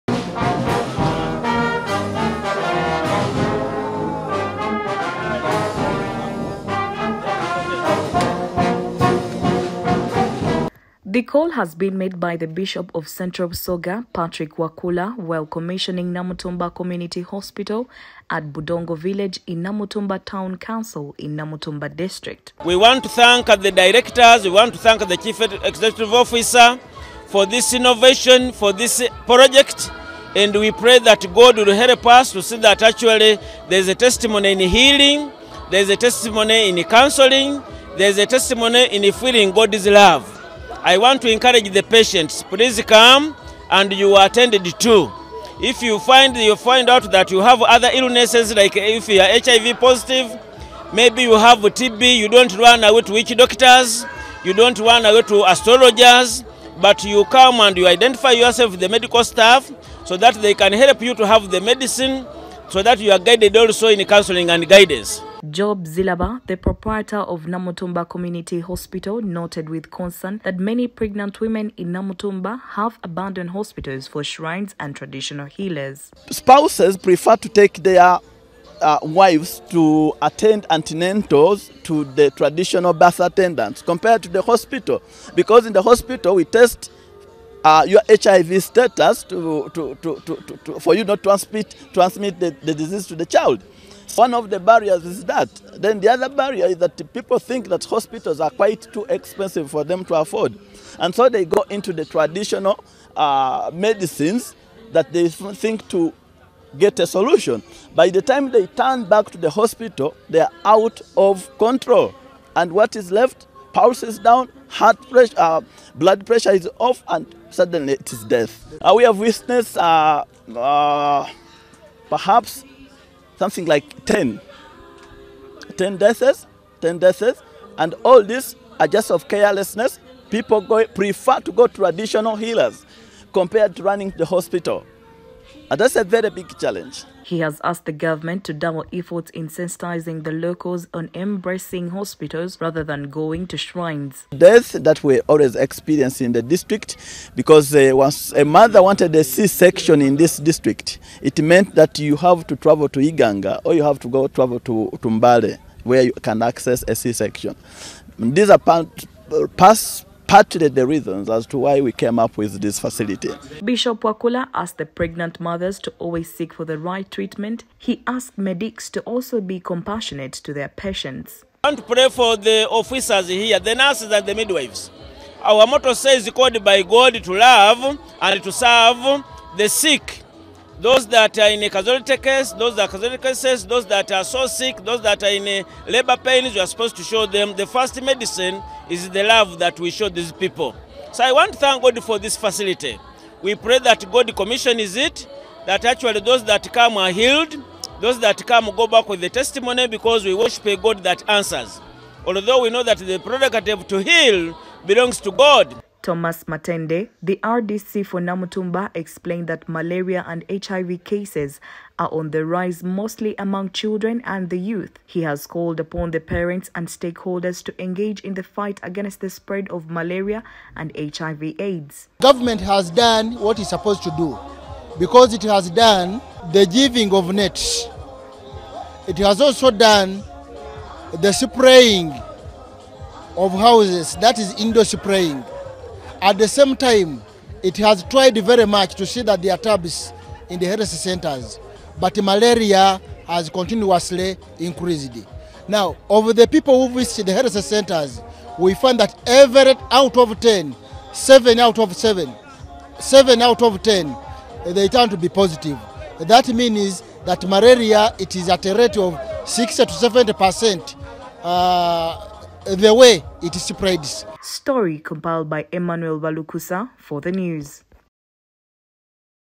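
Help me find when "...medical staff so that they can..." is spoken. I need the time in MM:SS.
00:58.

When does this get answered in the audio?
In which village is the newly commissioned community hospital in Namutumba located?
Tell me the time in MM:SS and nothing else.
00:18.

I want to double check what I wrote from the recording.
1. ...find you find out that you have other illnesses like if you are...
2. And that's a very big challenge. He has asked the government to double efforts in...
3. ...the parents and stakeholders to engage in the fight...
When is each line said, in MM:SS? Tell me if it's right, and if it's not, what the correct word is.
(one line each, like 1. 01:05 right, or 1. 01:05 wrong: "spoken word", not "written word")
1. 00:45 right
2. 02:15 right
3. 03:36 right.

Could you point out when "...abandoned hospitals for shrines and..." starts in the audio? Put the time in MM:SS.
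01:13.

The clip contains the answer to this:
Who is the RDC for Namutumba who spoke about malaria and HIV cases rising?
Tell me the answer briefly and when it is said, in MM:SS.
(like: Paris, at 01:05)
Thomas Matende, at 03:26.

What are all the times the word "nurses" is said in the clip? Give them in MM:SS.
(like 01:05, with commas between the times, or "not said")
02:53.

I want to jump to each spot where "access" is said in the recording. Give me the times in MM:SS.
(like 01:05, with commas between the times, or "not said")
02:36.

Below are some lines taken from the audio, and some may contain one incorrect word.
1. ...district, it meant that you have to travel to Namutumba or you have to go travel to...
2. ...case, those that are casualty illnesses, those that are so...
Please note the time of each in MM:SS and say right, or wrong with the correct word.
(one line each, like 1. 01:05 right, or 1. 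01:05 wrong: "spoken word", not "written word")
1. 02:30 wrong: "Iganga", not "Namutumba"
2. 03:02 wrong: "cases", not "illnesses".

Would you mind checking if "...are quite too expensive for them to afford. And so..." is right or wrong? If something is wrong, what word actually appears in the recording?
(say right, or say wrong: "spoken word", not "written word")
right.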